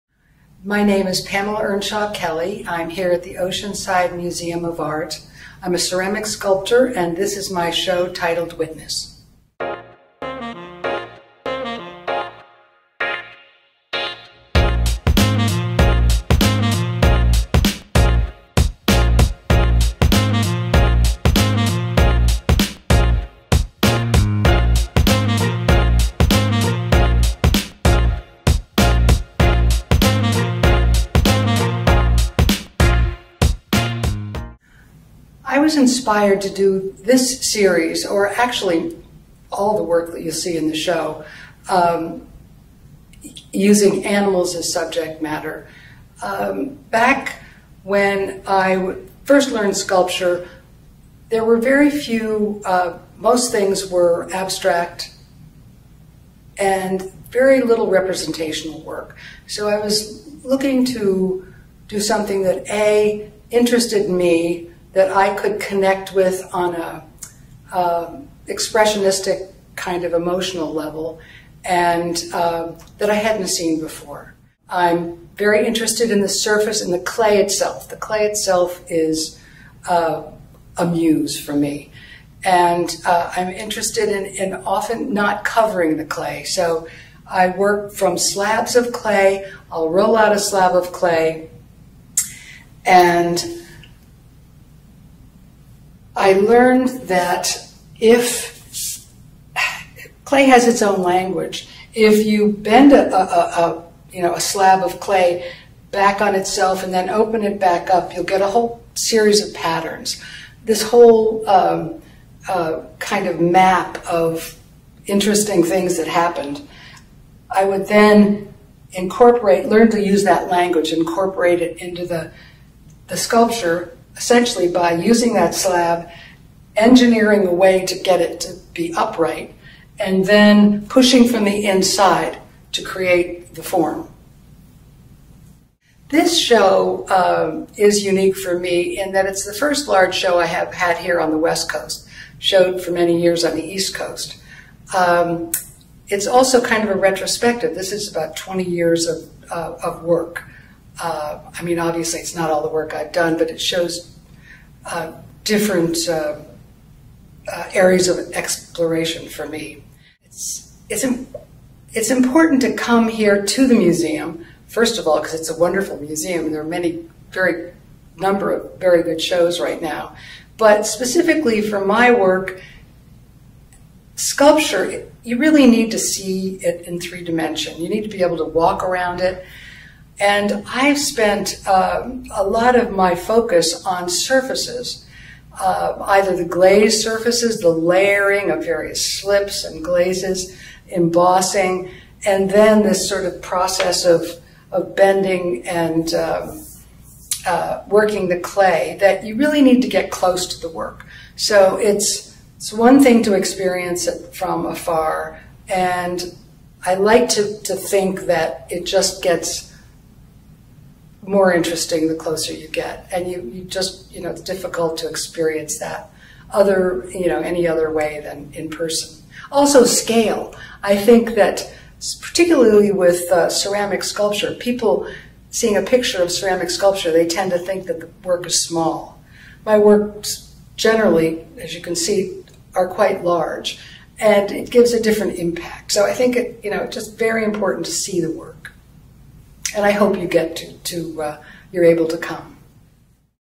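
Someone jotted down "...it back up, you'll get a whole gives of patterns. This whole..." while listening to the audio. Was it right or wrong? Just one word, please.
wrong.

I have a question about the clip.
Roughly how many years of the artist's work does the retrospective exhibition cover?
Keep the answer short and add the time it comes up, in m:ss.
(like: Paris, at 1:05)
20, at 2:28.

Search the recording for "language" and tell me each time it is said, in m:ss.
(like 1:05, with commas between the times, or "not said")
1:41, 2:00.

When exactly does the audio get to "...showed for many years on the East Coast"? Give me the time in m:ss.
2:22.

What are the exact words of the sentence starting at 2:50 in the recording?
But specifically for my work, sculpture, you really need to see it in three dimension.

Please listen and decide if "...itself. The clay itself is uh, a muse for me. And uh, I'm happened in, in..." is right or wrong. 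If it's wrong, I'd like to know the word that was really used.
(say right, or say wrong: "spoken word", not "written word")
wrong: "interested", not "happened".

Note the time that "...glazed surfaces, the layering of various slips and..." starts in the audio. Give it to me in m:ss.
3:06.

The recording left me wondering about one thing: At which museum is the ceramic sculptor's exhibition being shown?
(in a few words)
Oceanside Museum of Art.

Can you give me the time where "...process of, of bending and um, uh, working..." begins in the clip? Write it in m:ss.
3:13.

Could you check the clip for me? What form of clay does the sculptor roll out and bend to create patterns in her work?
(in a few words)
slabs.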